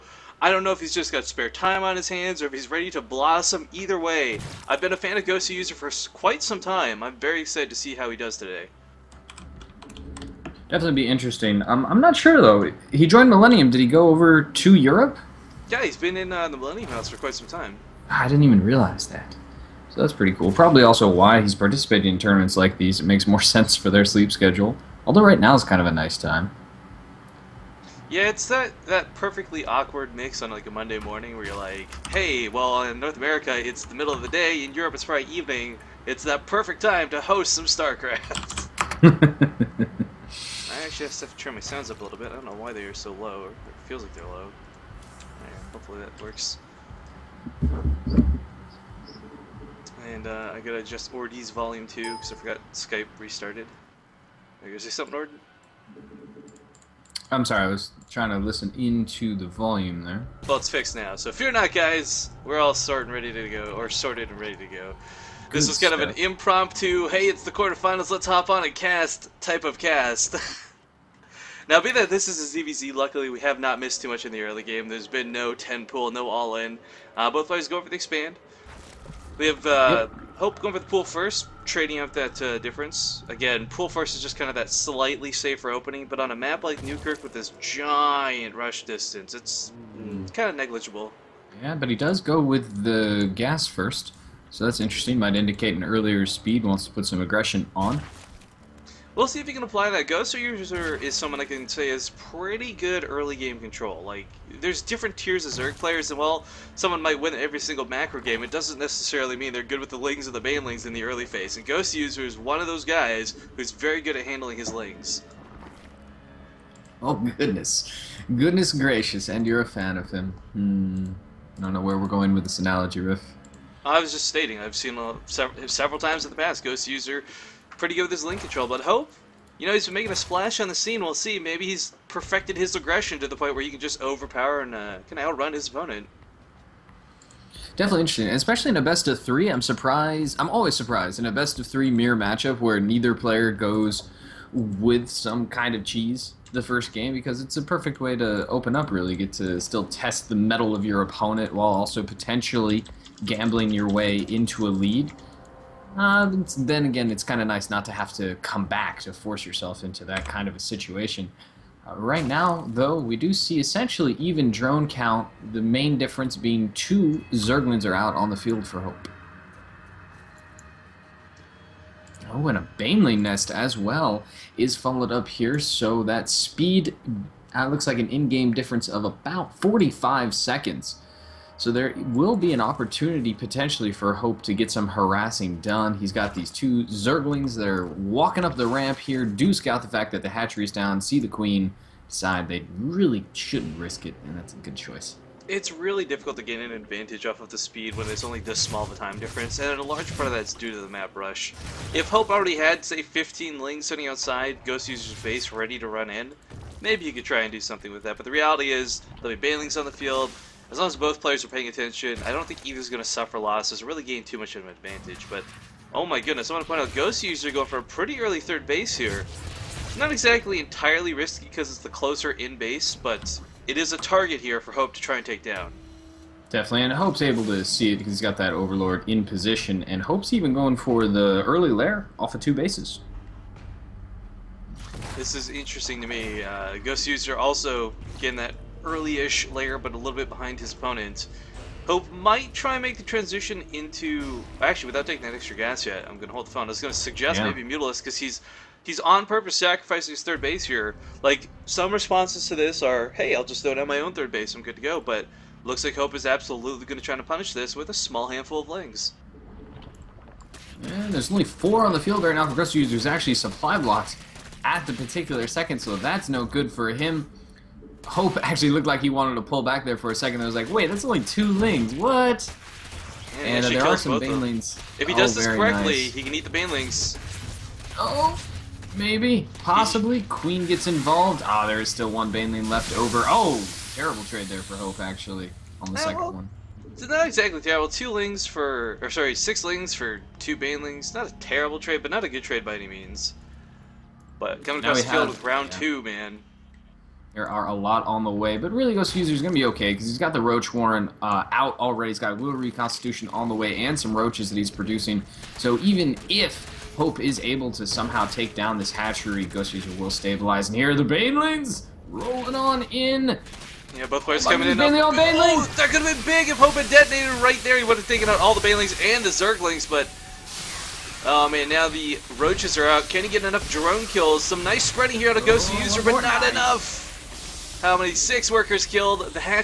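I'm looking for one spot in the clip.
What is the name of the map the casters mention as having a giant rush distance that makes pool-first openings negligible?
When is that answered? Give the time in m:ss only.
1:26.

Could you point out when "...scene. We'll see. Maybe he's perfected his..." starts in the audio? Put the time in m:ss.
2:10.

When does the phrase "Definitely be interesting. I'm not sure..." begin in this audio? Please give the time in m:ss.
0:10.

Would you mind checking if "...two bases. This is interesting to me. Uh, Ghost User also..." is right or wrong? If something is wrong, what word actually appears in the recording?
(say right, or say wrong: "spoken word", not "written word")
right.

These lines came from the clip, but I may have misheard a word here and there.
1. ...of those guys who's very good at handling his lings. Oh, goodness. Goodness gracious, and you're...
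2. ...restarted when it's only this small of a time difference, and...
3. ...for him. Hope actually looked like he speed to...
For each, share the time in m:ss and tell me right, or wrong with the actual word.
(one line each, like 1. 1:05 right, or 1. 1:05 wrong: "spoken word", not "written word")
1. 1:52 right
2. 3:17 wrong: "speed", not "restarted"
3. 4:26 wrong: "wanted", not "speed".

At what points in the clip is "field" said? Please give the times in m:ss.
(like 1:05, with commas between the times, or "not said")
2:48, 3:29, 4:21, 4:55.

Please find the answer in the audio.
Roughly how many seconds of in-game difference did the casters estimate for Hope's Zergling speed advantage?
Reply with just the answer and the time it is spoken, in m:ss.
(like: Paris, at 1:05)
45 seconds, at 2:59.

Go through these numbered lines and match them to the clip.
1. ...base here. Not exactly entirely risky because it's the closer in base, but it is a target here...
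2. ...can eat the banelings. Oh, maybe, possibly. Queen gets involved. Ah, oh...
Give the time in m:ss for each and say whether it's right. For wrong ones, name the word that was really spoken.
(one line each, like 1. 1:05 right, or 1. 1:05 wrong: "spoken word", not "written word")
1. 3:38 right
2. 4:36 right.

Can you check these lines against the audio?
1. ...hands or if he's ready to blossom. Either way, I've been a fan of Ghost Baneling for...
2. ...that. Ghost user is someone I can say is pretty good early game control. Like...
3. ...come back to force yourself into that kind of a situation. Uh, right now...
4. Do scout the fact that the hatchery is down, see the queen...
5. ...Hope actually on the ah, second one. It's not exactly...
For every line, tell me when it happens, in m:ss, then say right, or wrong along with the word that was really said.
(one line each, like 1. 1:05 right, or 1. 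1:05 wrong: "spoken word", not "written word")
1. 0:02 wrong: "User", not "Baneling"
2. 1:39 right
3. 2:38 right
4. 3:09 right
5. 4:44 right.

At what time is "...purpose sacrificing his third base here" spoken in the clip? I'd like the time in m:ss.
4:09.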